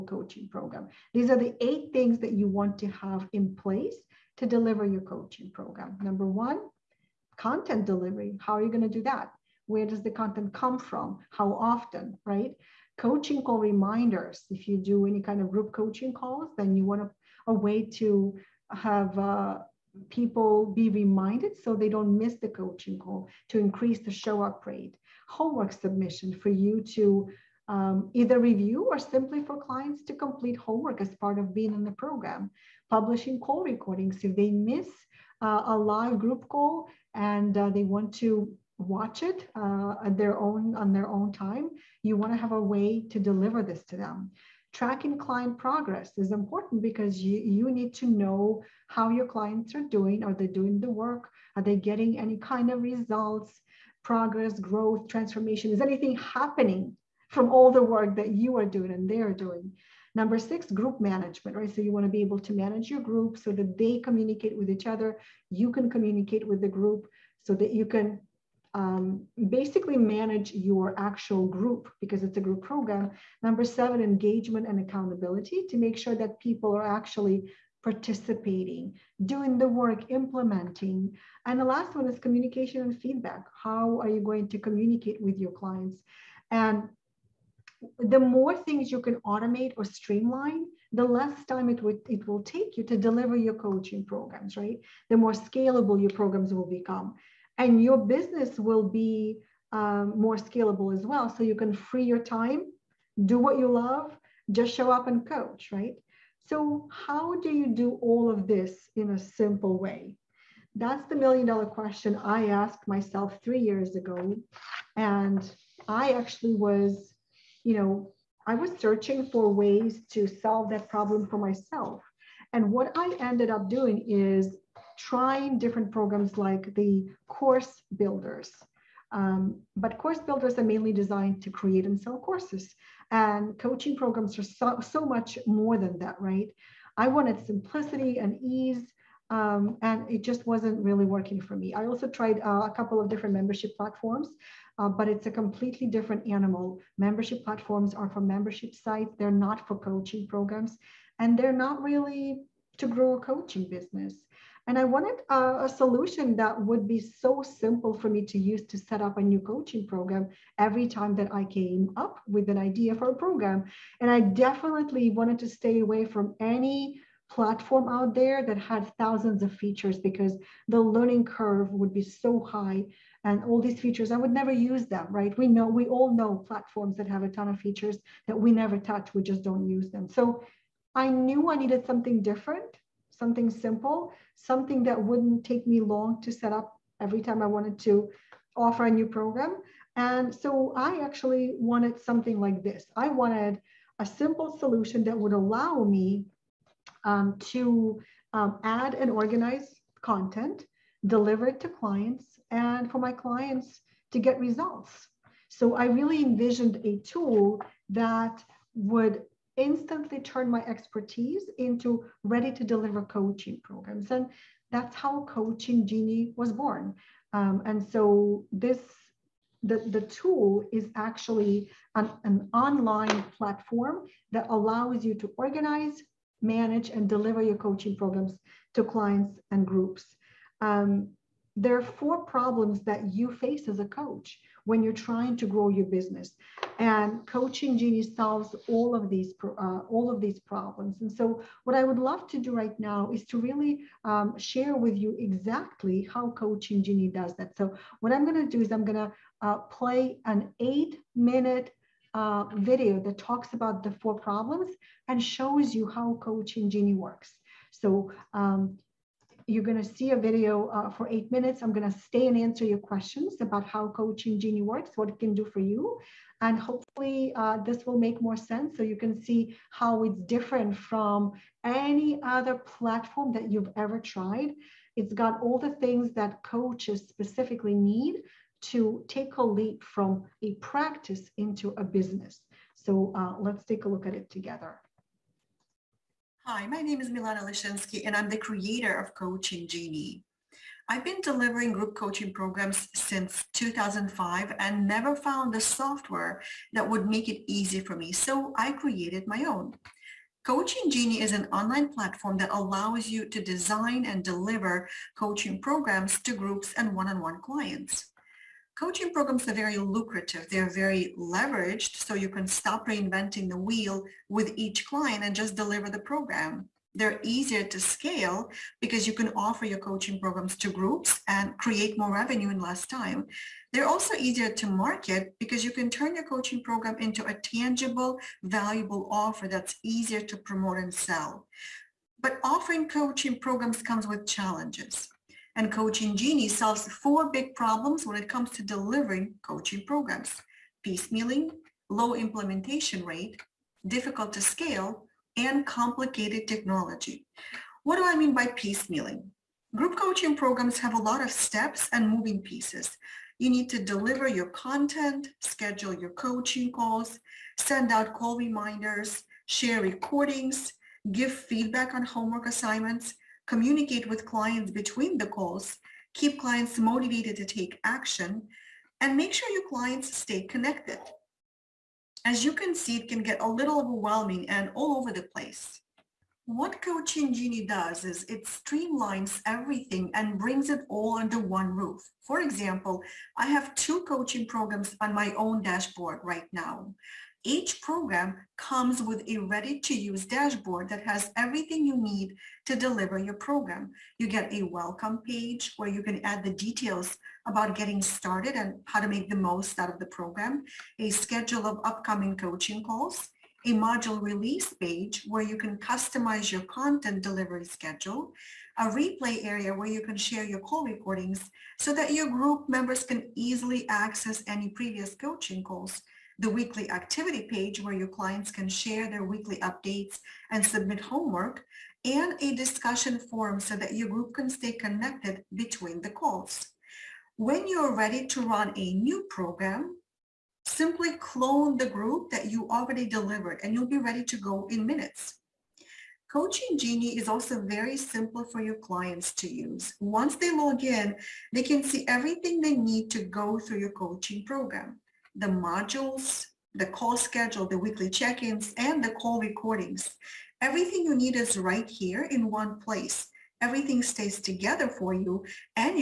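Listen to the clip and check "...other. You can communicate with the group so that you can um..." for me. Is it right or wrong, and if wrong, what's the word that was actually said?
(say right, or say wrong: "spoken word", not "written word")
right.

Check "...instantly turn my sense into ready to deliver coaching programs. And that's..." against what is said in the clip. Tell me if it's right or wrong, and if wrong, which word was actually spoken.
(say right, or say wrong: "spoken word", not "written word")
wrong: "expertise", not "sense".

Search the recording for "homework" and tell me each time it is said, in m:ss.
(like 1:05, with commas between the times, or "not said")
0:25, 0:30, 6:02, 7:01.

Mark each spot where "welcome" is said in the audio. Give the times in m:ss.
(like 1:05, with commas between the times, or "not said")
6:34.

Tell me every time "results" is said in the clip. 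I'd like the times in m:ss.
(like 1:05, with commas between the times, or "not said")
0:52, 3:24.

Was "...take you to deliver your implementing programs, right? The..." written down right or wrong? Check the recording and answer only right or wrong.
wrong.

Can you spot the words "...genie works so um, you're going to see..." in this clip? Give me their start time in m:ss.
4:16.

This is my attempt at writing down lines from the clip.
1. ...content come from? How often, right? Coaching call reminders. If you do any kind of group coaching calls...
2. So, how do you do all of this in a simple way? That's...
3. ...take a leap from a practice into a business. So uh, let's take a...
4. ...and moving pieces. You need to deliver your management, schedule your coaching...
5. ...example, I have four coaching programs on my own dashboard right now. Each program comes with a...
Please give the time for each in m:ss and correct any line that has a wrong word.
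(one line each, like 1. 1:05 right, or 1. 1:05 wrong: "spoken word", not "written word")
1. 0:10 right
2. 1:46 right
3. 4:39 right
4. 5:51 wrong: "content", not "management"
5. 6:22 wrong: "two", not "four".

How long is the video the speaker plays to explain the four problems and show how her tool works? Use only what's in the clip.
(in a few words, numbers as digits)
8 minutes.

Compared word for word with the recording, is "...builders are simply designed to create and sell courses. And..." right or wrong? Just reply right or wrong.
wrong.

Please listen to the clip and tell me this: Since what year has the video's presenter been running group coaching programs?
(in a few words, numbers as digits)
2005.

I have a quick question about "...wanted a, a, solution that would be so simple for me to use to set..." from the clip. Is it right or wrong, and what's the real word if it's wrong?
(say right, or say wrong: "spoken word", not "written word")
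right.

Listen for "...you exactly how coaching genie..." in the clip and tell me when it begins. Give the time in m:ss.
4:04.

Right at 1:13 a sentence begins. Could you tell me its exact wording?
Number seven, engagement and accountability to make sure that people are actually participating, doing the work, implementing.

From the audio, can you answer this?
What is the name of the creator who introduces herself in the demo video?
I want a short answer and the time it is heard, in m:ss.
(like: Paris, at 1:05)
Milana Leshinsky, at 4:47.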